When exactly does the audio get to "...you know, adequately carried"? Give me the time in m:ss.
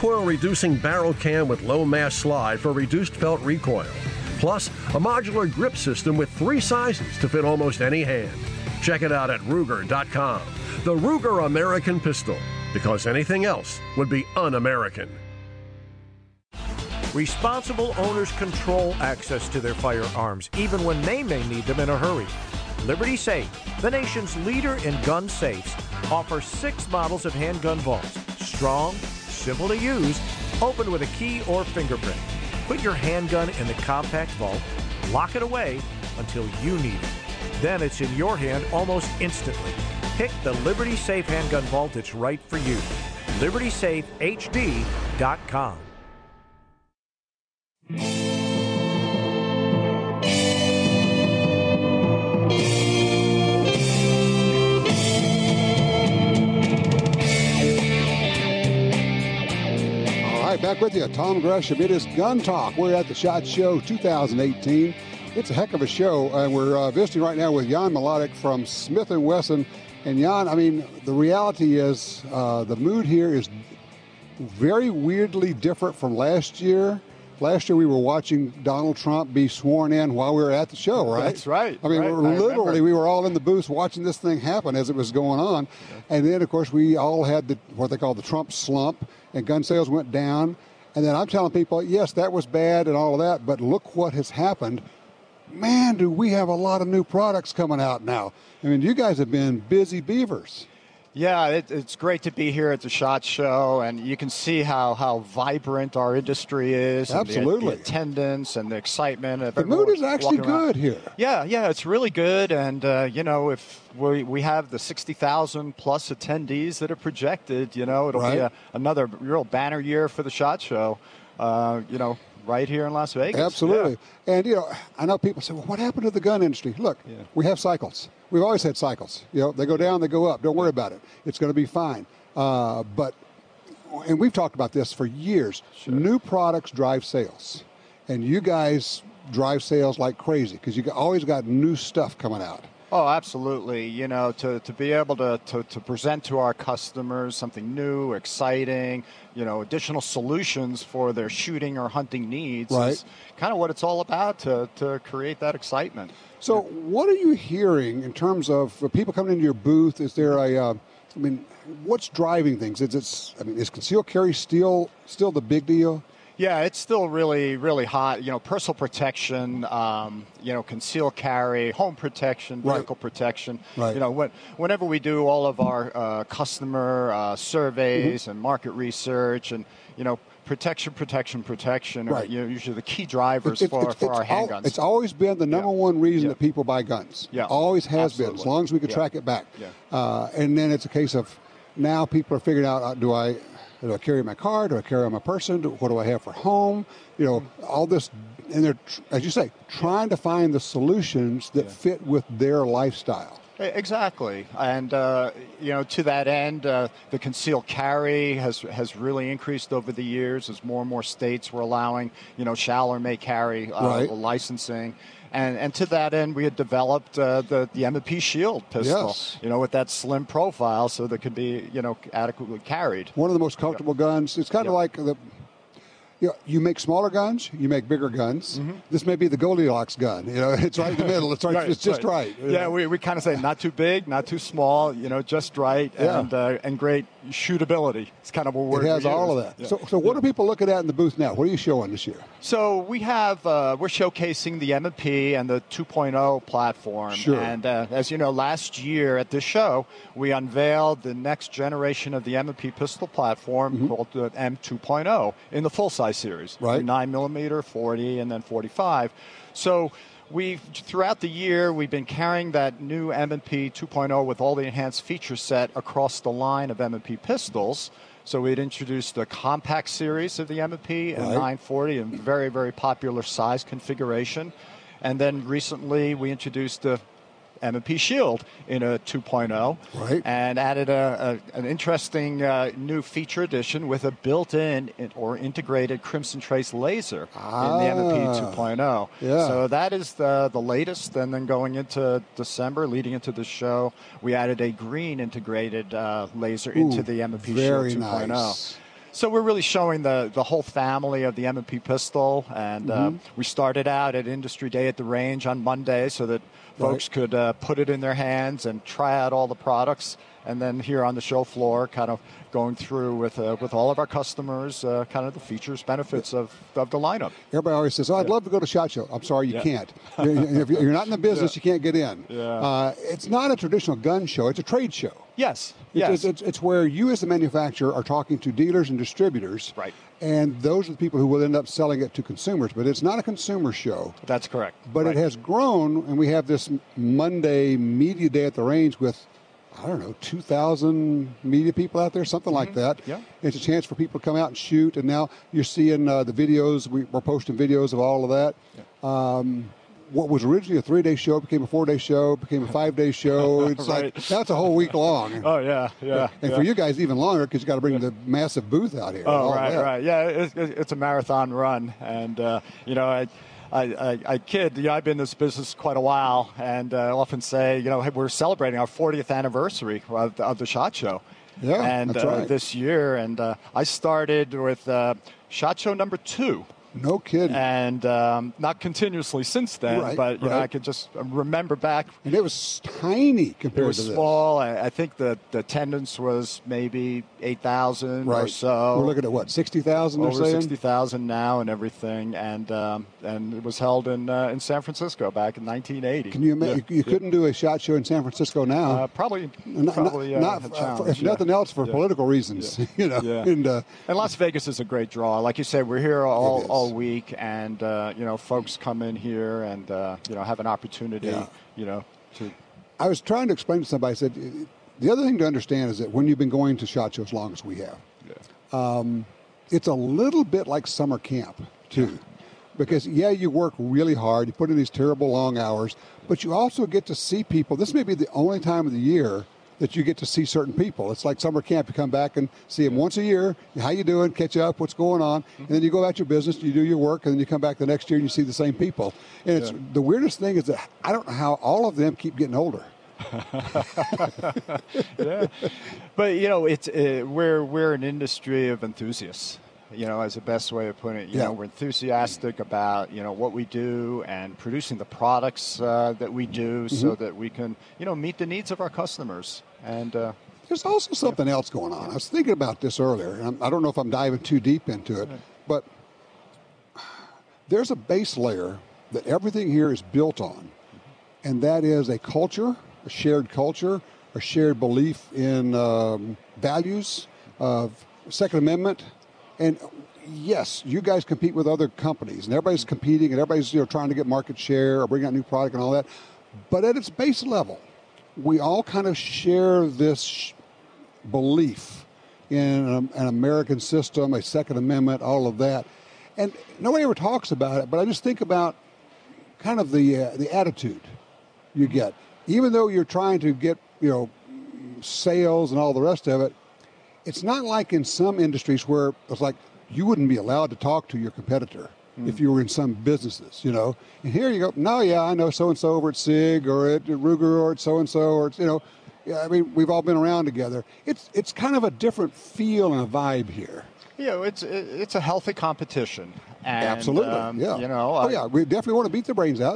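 3:41.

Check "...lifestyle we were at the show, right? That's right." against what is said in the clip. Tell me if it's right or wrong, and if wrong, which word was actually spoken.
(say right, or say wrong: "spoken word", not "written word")
wrong: "while", not "lifestyle".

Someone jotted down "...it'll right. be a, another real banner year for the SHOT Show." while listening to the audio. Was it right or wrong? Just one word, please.
right.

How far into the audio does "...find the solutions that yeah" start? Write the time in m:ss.
3:20.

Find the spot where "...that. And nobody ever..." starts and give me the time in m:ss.
8:15.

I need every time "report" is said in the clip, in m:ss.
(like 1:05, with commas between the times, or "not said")
not said.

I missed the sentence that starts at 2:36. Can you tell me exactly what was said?
So, what are you hearing in terms of people coming into your booth?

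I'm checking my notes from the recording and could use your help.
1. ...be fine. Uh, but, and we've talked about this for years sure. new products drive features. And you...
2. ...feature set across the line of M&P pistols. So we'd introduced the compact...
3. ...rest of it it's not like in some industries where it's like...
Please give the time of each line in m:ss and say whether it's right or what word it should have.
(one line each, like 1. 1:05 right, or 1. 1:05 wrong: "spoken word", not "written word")
1. 2:11 wrong: "sales", not "features"
2. 4:25 right
3. 8:26 right.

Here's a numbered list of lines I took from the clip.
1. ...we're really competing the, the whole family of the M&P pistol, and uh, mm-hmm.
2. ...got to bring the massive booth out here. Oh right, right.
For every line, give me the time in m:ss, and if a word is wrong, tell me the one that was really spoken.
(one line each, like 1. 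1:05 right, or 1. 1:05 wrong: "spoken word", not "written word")
1. 4:59 wrong: "showing", not "competing"
2. 5:57 right.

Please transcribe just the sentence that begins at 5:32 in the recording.
But it's not a consumer show.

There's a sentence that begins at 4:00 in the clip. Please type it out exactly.
are people looking at in the booth now?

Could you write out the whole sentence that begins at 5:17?
Everybody always says, "Oh, I'd yeah.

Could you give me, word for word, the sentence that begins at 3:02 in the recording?
are you know, usually the key drivers it, for, it, for our handguns.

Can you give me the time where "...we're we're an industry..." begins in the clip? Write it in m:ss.
7:27.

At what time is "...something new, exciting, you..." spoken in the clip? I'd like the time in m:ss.
2:27.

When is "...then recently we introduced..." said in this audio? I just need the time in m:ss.
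4:35.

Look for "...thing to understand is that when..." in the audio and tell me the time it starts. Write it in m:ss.
6:55.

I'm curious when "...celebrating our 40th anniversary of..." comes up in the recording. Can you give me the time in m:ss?
6:08.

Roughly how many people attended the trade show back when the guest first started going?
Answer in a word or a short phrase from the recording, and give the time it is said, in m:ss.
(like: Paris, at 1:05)
8,000, at 6:27.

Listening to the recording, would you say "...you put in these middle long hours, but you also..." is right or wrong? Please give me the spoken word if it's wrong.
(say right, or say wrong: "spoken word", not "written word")
wrong: "terrible", not "middle".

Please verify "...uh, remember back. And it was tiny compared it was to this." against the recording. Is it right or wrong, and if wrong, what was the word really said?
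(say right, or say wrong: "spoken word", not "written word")
right.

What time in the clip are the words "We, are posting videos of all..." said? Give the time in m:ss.
5:46.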